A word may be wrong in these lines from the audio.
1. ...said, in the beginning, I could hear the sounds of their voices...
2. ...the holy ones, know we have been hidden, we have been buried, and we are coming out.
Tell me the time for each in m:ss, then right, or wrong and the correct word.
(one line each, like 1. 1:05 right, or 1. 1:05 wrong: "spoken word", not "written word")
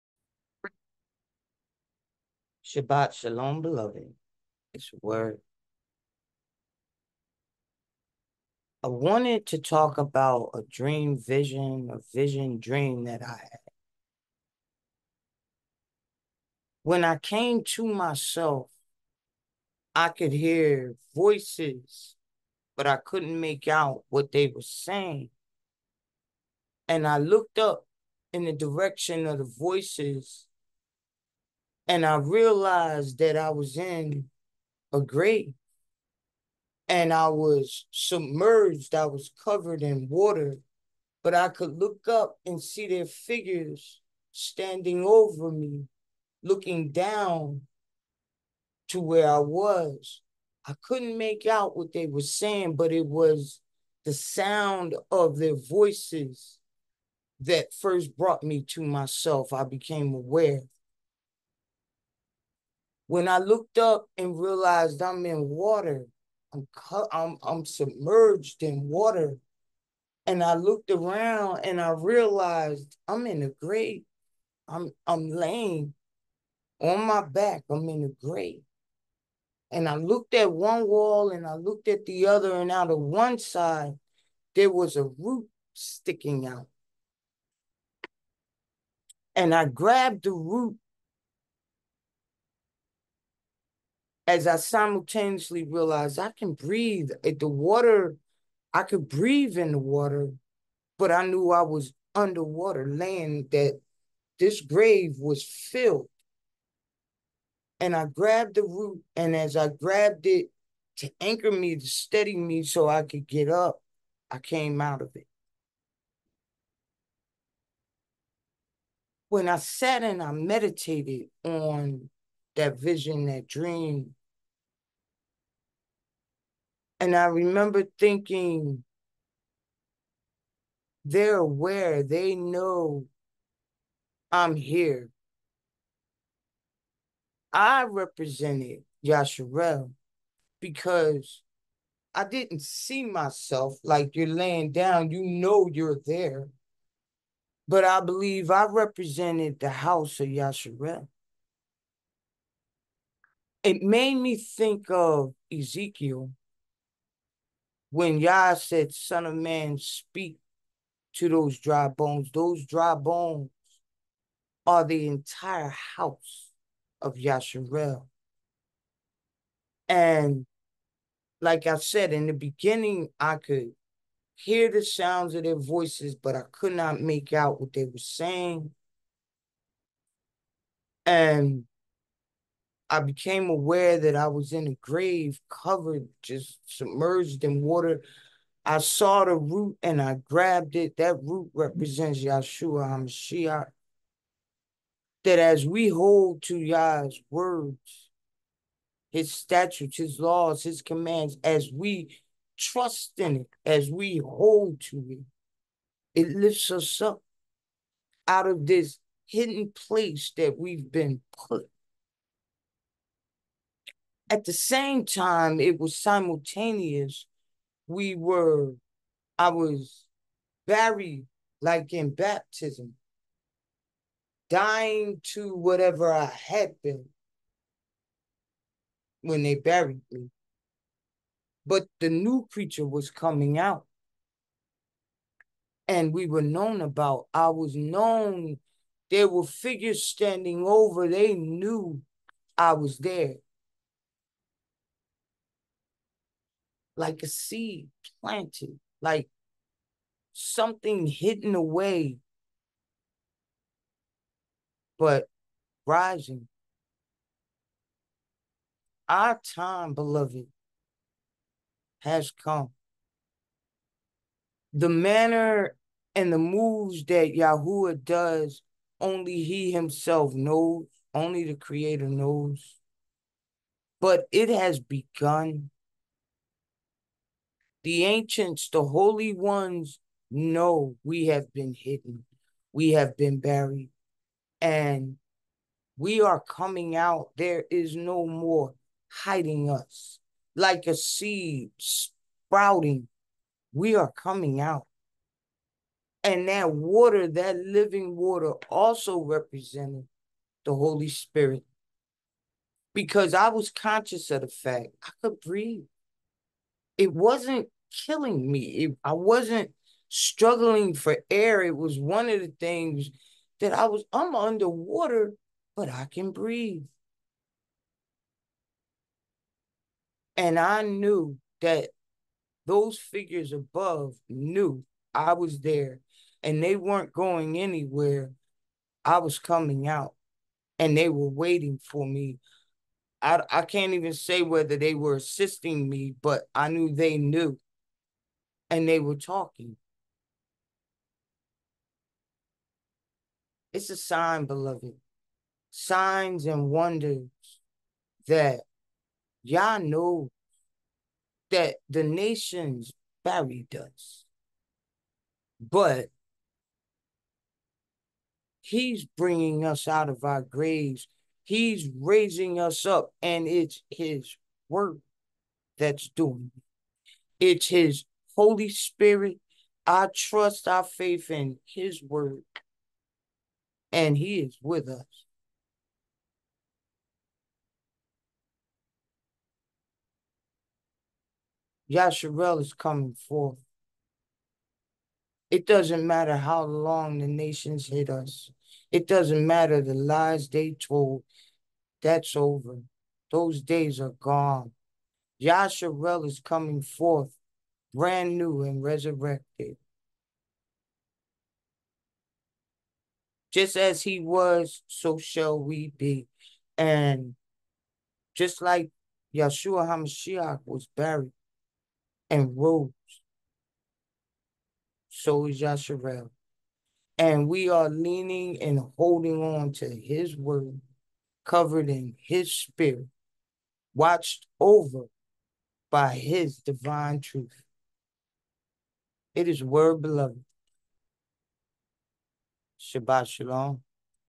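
1. 2:51 right
2. 4:38 right.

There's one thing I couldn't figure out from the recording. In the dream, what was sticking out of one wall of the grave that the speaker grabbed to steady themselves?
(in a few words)
A root.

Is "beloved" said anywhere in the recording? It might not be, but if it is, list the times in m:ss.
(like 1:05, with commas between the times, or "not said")
0:03, 4:19, 5:44, 7:10.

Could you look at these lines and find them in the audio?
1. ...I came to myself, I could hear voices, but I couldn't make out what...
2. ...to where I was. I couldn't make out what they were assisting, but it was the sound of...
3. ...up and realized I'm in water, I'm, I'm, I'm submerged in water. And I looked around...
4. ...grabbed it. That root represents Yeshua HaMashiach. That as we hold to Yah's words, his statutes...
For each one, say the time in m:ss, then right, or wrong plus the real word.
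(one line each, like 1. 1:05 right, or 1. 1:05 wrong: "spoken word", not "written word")
1. 0:17 right
2. 0:48 wrong: "saying", not "assisting"
3. 1:03 right
4. 3:10 right.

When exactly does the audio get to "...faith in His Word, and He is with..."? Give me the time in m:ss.
6:10.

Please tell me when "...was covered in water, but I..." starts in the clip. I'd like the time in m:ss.
0:39.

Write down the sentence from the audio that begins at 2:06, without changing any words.
And I remember thinking, they're aware, they know I'm here.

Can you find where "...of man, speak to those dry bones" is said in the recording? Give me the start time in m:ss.
2:39.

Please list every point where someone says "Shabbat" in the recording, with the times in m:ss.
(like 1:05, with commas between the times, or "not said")
0:02, 7:12.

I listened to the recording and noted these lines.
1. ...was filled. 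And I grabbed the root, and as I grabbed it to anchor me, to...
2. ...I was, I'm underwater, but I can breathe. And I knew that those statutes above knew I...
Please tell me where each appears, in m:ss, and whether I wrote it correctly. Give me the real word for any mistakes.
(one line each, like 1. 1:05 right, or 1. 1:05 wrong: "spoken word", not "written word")
1. 1:45 right
2. 5:13 wrong: "figures", not "statutes".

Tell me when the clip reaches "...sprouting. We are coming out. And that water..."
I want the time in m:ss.
4:51.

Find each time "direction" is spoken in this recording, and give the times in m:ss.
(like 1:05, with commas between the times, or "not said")
0:28.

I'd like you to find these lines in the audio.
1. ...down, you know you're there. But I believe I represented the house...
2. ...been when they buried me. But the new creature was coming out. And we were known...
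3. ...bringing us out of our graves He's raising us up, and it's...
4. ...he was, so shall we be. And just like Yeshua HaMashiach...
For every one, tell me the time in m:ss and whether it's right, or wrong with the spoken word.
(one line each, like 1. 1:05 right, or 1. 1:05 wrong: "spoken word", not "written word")
1. 2:24 right
2. 3:46 right
3. 5:59 right
4. 6:44 right.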